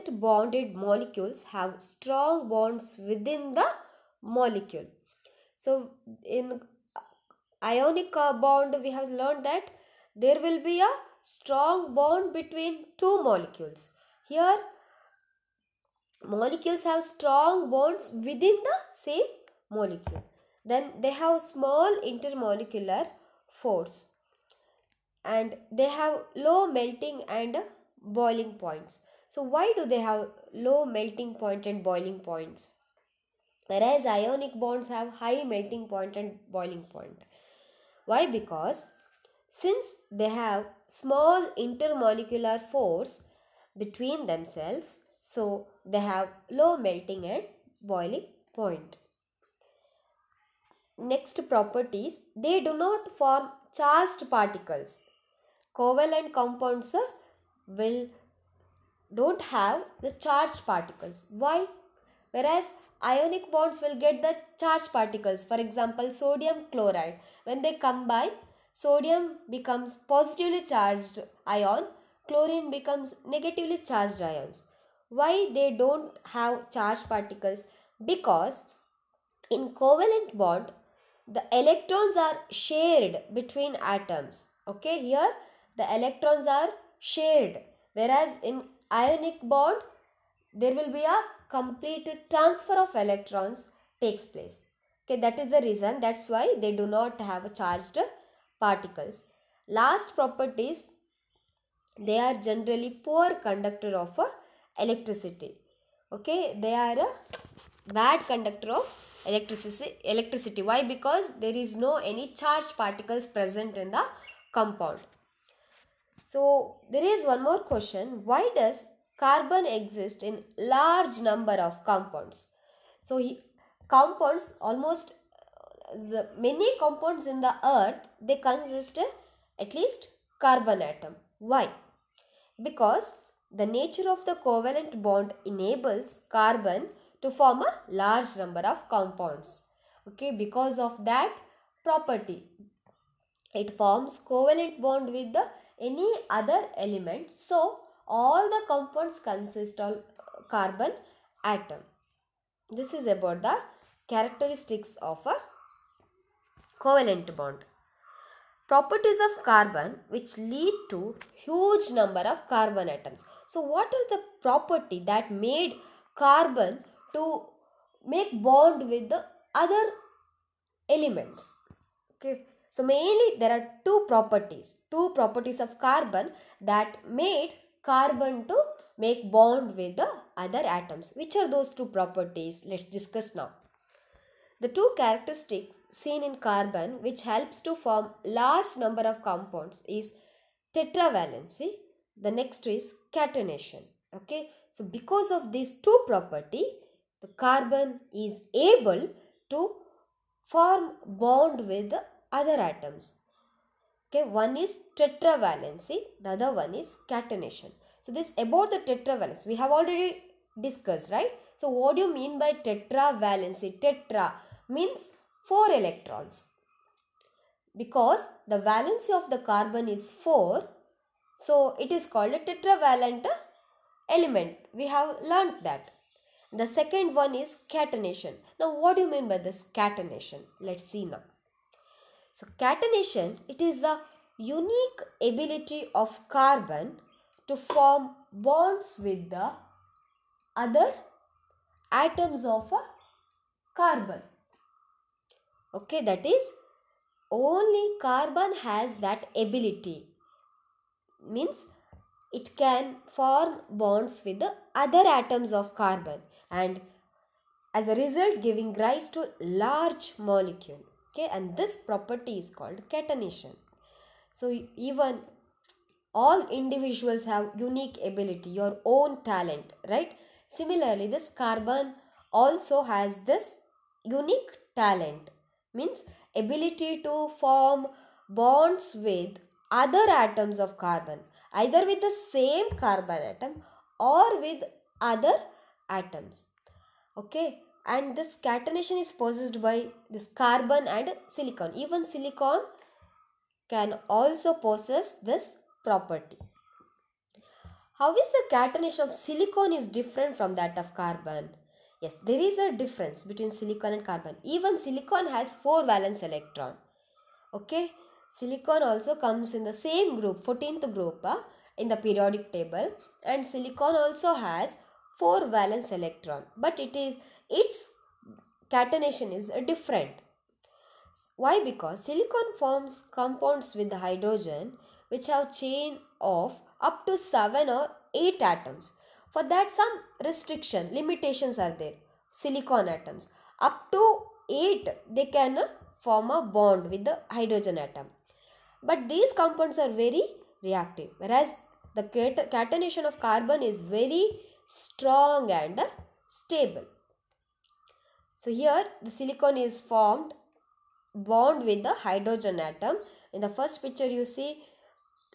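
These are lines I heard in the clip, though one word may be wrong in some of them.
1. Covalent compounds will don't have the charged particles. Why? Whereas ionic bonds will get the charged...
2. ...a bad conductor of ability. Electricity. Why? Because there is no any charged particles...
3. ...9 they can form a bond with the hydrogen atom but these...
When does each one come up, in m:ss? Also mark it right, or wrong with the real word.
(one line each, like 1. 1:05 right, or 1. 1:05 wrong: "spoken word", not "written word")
1. 0:55 right
2. 1:46 wrong: "electricity", not "ability"
3. 5:34 wrong: "8", not "9".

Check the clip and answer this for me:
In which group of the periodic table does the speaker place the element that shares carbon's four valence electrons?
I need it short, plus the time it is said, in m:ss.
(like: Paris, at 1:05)
14th group, at 5:10.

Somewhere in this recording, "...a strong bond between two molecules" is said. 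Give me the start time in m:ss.
0:10.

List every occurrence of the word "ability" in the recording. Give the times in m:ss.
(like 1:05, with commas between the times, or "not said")
3:55, 4:09, 4:28, 4:36.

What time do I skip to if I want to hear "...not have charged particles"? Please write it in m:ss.
1:36.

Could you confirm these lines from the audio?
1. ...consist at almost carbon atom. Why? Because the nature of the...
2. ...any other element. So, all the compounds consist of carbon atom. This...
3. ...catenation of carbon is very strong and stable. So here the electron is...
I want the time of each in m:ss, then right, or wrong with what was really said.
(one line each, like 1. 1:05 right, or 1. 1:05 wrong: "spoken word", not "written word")
1. 2:08 wrong: "least", not "almost"
2. 2:25 right
3. 5:42 wrong: "silicon", not "electron".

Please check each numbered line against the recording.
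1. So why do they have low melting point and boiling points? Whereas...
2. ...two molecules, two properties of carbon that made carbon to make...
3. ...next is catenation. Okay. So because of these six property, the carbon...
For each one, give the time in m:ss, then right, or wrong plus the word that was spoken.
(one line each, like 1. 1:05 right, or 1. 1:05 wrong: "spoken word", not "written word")
1. 0:29 right
2. 2:53 wrong: "properties", not "molecules"
3. 3:12 wrong: "two", not "six".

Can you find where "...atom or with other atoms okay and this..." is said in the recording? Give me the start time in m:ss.
4:43.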